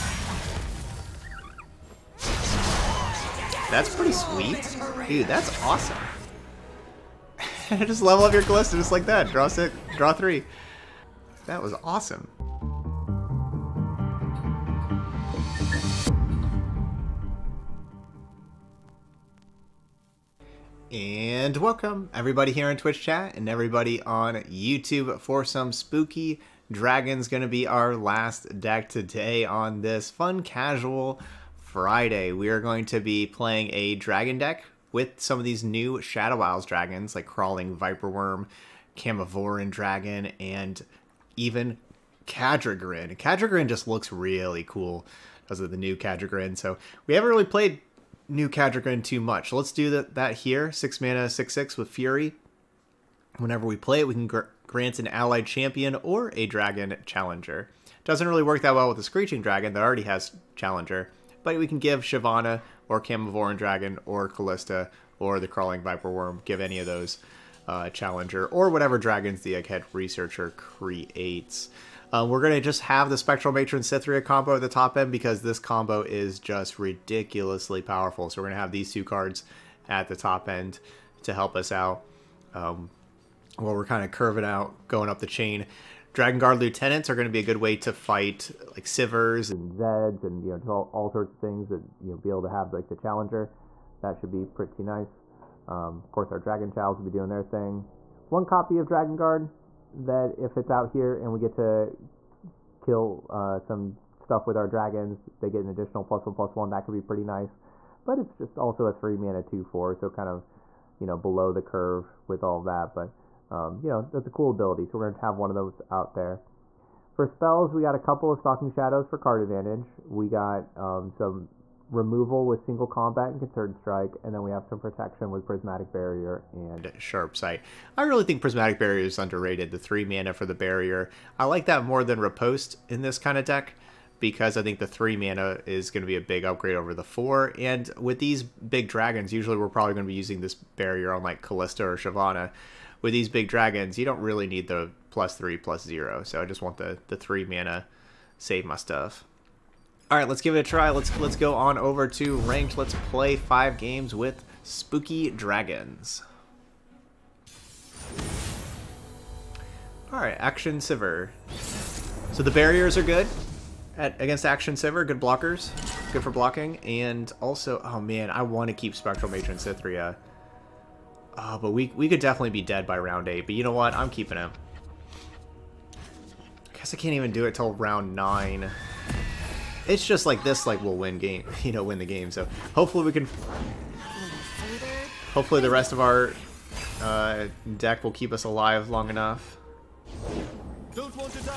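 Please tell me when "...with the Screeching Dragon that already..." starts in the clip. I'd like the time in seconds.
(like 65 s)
58 s.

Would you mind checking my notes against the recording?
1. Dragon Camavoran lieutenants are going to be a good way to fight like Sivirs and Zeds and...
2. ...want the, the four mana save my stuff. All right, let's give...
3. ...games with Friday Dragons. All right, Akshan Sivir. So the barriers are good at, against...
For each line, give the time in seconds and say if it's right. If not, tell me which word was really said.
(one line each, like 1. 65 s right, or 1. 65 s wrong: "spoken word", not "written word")
1. 86 s wrong: "Guard", not "Camavoran"
2. 146 s wrong: "three", not "four"
3. 153 s wrong: "Spooky", not "Friday".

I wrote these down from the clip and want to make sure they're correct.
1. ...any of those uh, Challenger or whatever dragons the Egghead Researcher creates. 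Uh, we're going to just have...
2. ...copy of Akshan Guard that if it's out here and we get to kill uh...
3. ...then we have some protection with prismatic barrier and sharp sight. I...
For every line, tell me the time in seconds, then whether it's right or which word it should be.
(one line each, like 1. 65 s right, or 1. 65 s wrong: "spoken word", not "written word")
1. 66 s right
2. 98 s wrong: "Dragon", not "Akshan"
3. 124 s right.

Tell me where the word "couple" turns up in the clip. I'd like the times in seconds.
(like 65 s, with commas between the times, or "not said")
117 s.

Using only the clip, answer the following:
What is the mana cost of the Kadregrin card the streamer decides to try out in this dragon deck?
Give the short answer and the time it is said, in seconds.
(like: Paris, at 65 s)
6, at 50 s.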